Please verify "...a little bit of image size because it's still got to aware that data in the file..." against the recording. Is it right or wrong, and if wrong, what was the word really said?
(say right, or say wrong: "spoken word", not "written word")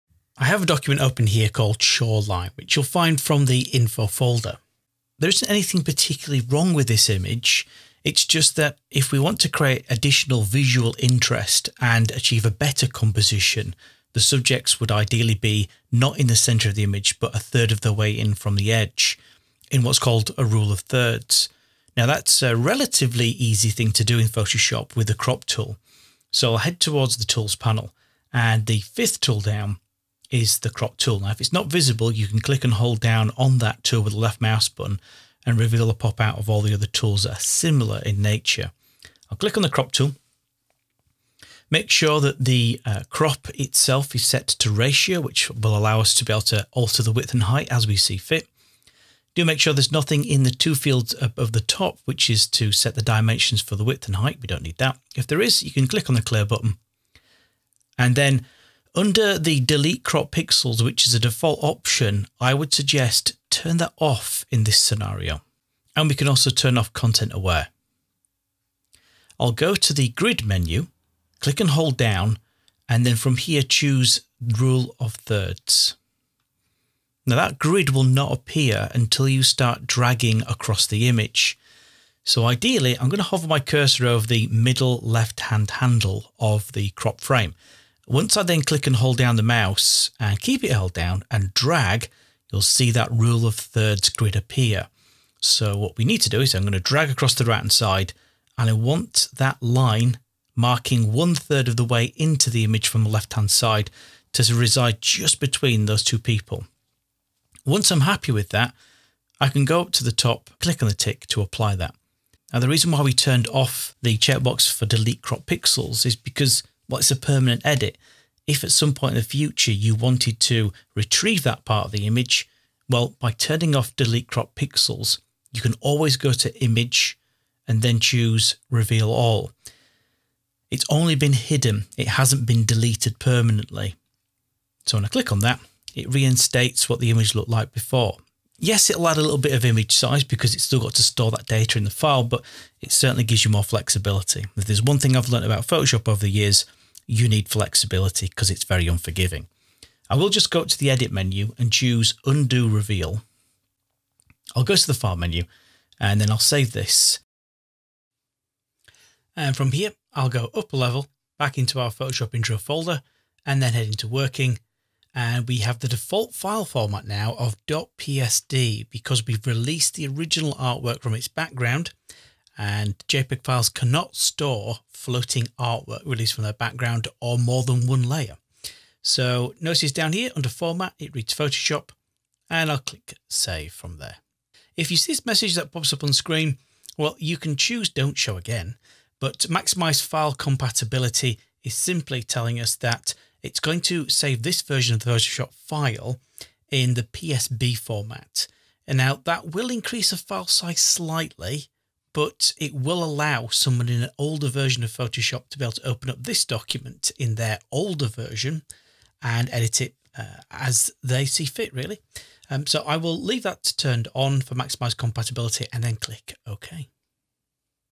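wrong: "store", not "aware".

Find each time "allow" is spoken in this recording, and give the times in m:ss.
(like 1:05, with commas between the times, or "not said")
0:45, 3:23.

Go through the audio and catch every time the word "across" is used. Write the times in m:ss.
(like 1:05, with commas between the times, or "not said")
1:20, 1:37.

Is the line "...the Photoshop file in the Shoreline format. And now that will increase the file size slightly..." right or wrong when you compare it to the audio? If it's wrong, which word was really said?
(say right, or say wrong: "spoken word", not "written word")
wrong: "PSD", not "Shoreline".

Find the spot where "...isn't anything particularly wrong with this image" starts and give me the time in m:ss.
0:05.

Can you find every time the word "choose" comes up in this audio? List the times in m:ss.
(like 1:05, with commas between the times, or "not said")
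1:13, 2:07, 2:31, 3:07.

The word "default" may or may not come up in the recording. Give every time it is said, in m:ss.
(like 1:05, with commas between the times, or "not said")
1:01, 2:45.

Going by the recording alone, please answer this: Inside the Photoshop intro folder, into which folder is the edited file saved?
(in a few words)
working.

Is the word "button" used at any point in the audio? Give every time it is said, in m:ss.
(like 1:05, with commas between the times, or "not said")
0:34, 0:56.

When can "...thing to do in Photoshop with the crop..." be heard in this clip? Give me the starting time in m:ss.
0:23.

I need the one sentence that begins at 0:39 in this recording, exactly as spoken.
I'll click on the crop tool.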